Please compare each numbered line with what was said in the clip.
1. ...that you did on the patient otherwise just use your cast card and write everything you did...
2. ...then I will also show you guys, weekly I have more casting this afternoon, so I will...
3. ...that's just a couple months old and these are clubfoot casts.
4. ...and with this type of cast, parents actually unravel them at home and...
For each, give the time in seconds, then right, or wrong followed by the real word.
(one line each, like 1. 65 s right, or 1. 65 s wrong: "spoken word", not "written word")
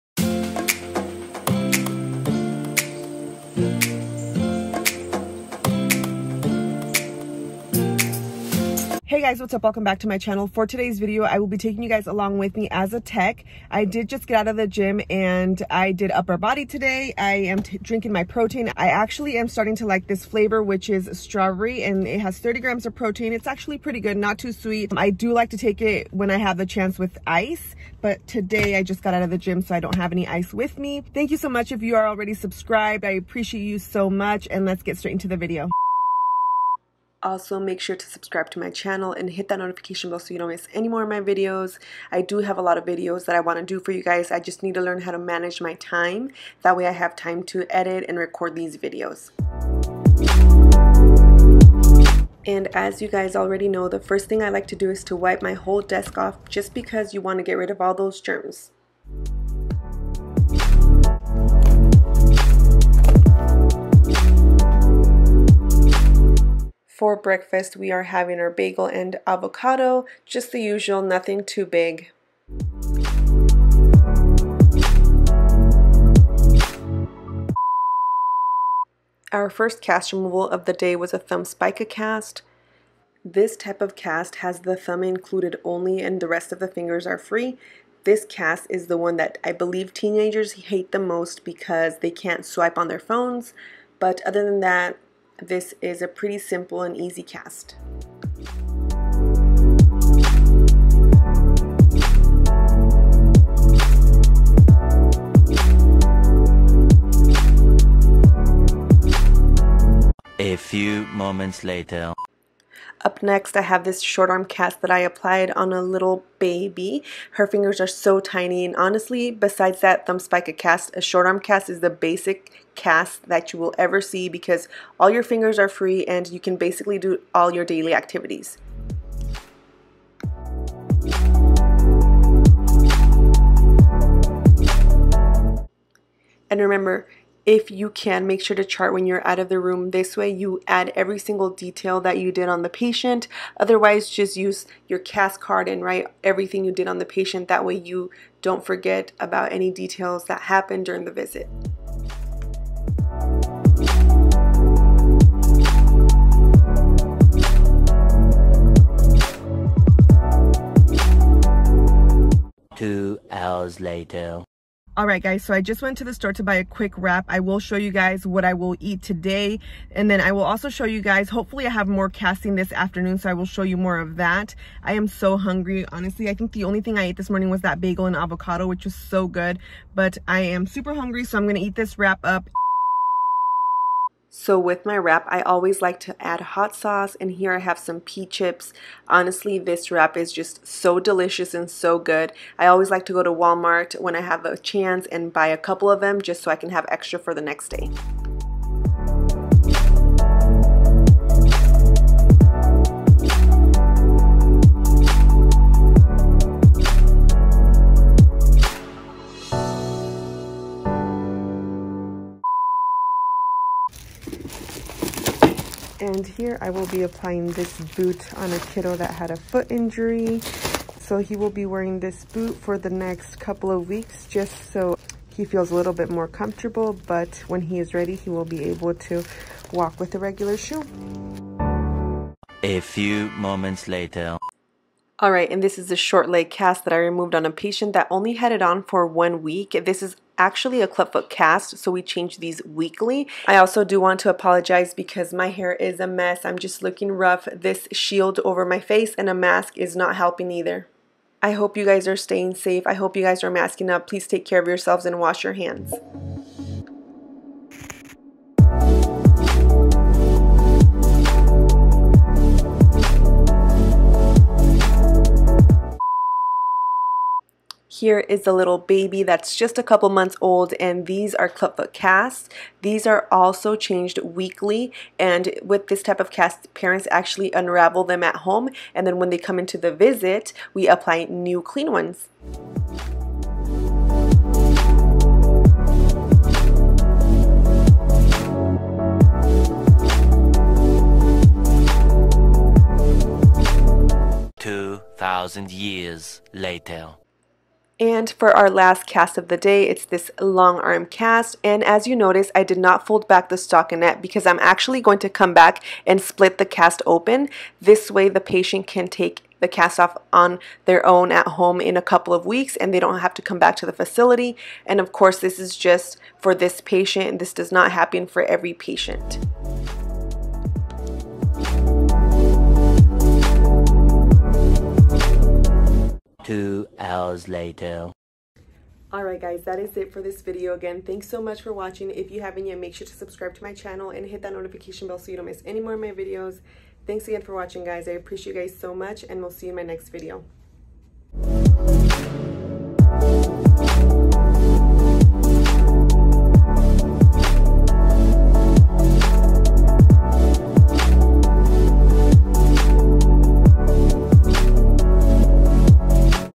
1. 141 s right
2. 170 s wrong: "hopefully", not "weekly"
3. 269 s right
4. 275 s right.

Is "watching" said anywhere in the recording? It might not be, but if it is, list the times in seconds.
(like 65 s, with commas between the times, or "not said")
331 s, 337 s.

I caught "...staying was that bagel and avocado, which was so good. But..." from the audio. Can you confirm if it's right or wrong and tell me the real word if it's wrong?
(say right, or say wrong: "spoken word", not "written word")
wrong: "morning", not "staying".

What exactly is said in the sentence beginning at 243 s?
I also do want to apologize because my hair is a mess.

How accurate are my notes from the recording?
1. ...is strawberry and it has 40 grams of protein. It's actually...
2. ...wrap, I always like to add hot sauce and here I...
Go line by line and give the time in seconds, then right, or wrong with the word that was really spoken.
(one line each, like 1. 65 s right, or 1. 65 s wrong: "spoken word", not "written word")
1. 20 s wrong: "30", not "40"
2. 184 s right.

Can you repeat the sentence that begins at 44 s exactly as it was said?
I just need to learn how to manage my time.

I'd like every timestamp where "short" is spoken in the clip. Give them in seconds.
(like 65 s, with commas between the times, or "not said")
113 s, 121 s, 235 s.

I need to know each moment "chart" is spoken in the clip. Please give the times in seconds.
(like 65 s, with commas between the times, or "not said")
138 s.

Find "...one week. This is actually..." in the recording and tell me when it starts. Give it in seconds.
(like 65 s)
239 s.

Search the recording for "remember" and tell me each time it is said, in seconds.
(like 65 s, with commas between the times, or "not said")
136 s.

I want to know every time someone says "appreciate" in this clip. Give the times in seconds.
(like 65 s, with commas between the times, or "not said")
33 s, 338 s.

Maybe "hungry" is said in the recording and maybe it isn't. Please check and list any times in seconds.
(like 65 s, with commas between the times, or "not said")
175 s, 180 s.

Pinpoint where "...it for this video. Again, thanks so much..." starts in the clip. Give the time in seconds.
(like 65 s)
329 s.